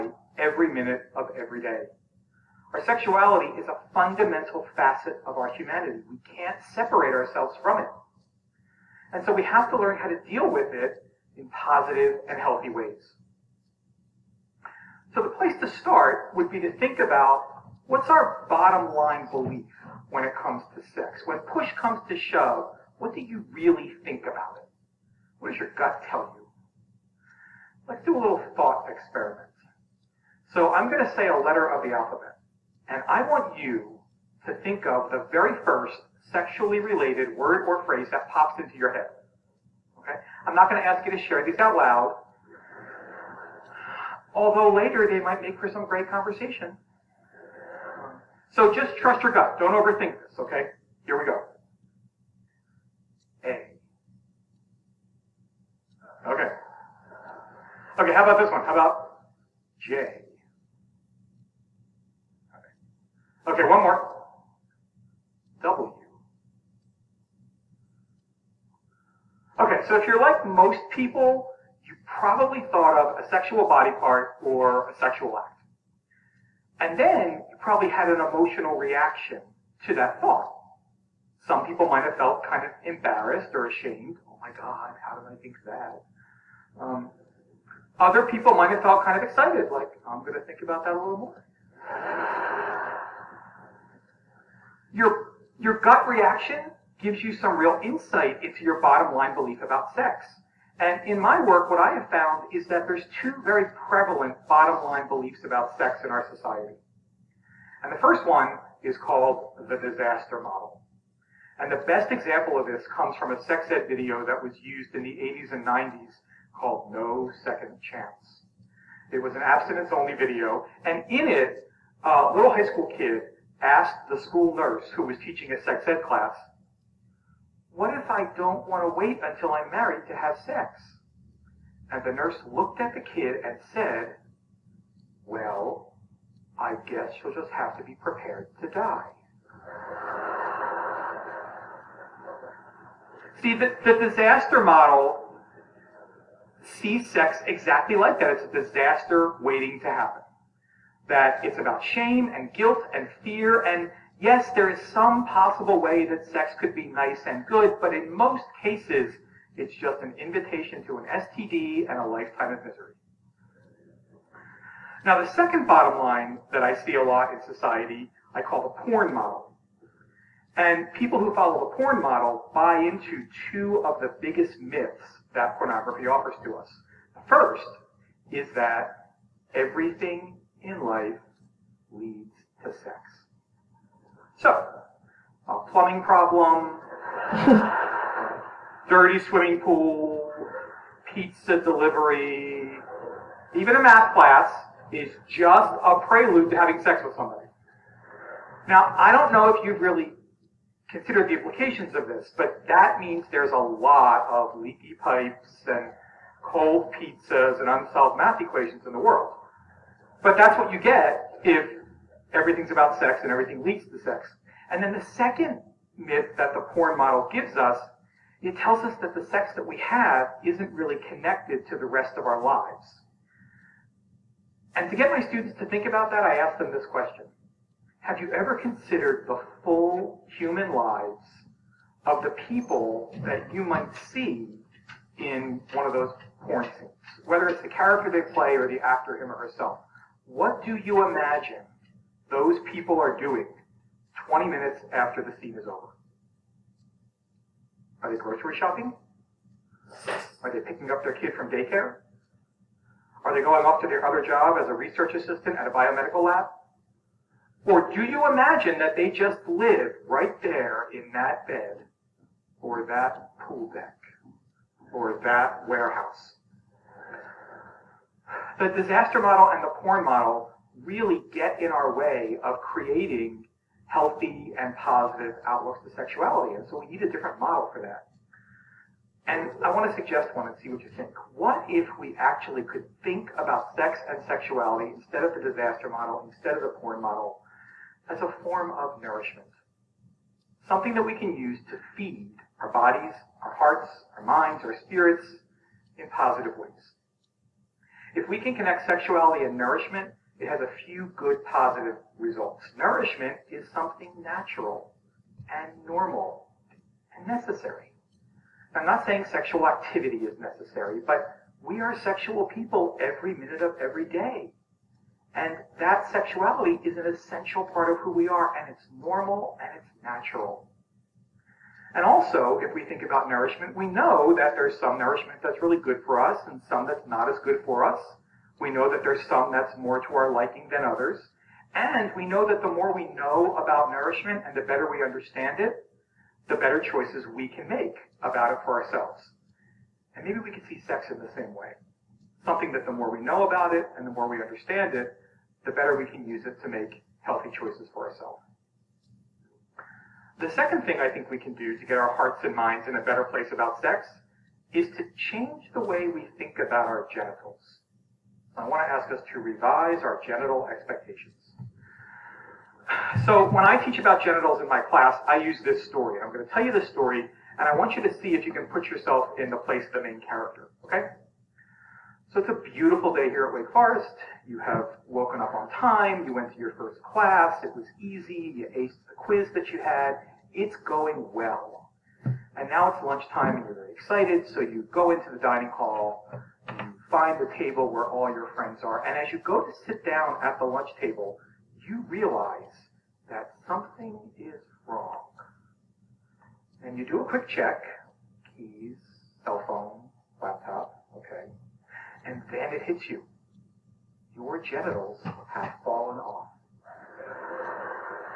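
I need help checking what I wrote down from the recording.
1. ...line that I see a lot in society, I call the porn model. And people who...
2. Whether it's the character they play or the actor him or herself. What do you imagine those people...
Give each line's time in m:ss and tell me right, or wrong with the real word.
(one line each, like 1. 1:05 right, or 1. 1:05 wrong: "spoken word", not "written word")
1. 2:45 right
2. 3:57 right.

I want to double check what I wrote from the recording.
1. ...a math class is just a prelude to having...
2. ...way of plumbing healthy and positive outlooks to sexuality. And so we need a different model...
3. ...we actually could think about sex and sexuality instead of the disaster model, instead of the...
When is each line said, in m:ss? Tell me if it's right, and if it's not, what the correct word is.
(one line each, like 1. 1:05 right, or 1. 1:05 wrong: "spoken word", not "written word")
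1. 3:13 right
2. 4:31 wrong: "creating", not "plumbing"
3. 4:41 right.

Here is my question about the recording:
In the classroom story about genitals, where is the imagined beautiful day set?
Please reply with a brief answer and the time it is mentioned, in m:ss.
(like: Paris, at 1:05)
Wake Forest, at 6:13.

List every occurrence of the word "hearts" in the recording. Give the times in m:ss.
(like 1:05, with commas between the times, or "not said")
4:53, 5:52.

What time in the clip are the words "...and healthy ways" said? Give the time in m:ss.
0:12.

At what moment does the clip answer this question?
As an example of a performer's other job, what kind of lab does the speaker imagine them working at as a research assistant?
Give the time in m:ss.
4:15.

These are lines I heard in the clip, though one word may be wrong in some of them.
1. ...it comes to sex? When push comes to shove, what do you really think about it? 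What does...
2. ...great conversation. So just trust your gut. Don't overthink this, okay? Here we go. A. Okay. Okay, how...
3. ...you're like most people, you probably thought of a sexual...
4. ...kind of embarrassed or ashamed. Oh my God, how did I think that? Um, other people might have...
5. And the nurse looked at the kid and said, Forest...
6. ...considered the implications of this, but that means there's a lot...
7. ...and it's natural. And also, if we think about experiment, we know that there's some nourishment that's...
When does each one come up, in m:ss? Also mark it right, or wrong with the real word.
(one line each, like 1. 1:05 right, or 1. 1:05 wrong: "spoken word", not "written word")
1. 0:20 right
2. 0:45 right
3. 1:10 right
4. 1:22 right
5. 2:11 wrong: "Well", not "Forest"
6. 3:20 right
7. 5:19 wrong: "nourishment", not "experiment".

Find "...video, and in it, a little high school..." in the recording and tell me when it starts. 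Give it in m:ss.
2:00.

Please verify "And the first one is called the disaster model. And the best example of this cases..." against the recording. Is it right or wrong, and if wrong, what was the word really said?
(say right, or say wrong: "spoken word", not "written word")
wrong: "comes", not "cases".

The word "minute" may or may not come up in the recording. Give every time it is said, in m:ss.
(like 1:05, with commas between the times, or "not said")
0:00, 4:04, 5:13.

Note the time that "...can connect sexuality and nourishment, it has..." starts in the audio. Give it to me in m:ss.
4:58.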